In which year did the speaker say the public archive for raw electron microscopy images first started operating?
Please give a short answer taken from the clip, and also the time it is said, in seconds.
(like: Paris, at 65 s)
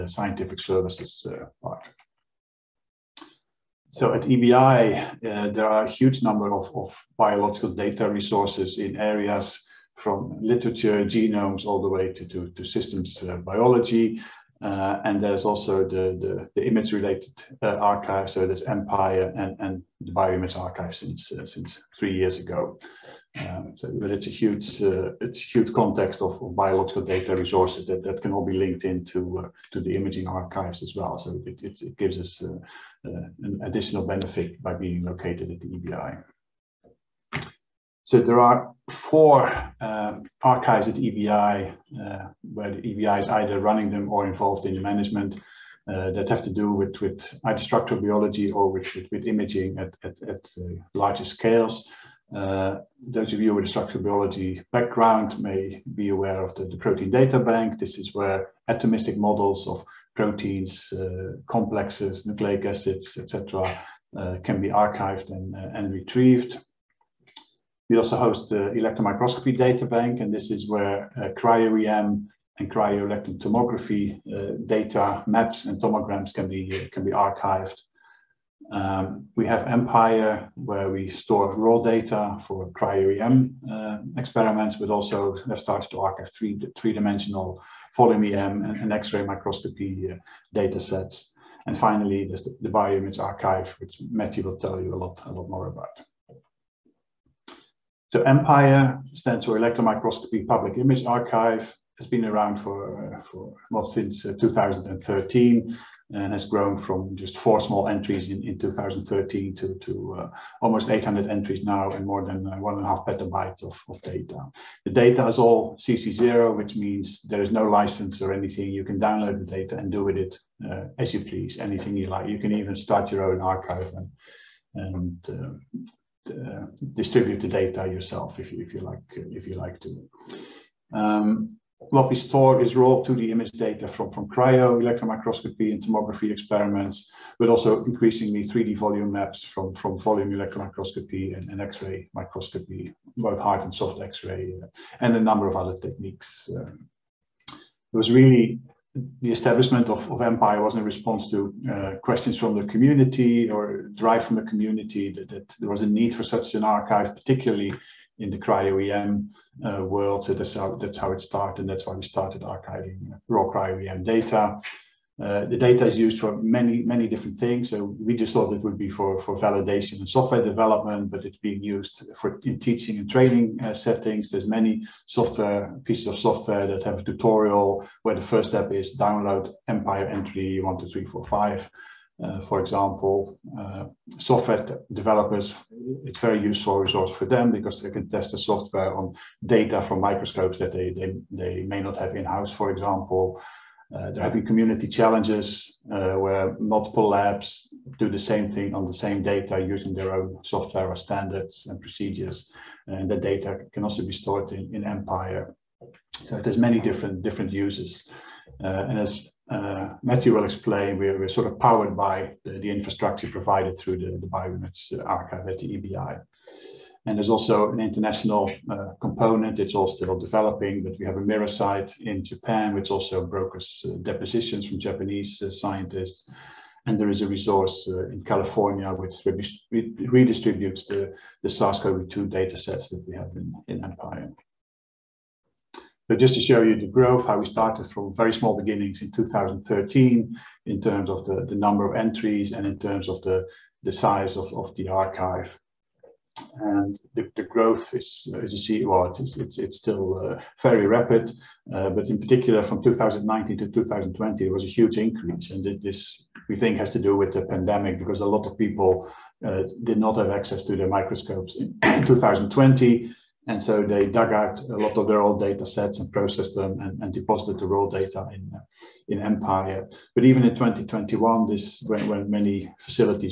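2013, at 103 s.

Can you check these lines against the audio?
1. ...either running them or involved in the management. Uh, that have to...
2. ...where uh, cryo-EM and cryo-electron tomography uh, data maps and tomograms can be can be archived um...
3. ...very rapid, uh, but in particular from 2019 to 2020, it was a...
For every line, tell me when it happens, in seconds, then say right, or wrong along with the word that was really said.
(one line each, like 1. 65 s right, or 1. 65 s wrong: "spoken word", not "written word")
1. 43 s right
2. 70 s right
3. 250 s right.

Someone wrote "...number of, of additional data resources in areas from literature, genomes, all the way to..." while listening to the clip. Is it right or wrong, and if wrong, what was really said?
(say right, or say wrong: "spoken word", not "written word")
wrong: "biological", not "additional".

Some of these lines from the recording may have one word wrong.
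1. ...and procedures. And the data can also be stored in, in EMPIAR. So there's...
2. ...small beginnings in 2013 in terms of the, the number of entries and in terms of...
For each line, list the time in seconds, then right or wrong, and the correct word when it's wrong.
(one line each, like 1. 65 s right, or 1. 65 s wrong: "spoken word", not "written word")
1. 201 s right
2. 238 s right.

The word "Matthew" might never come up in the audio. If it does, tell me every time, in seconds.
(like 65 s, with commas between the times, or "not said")
94 s, 210 s.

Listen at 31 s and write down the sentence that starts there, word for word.
So it, it, it gives us uh, uh an additional benefit by being located at the EBI.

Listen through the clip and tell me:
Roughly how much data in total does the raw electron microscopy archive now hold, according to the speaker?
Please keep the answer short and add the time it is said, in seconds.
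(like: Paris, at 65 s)
1.5 petabytes, at 112 s.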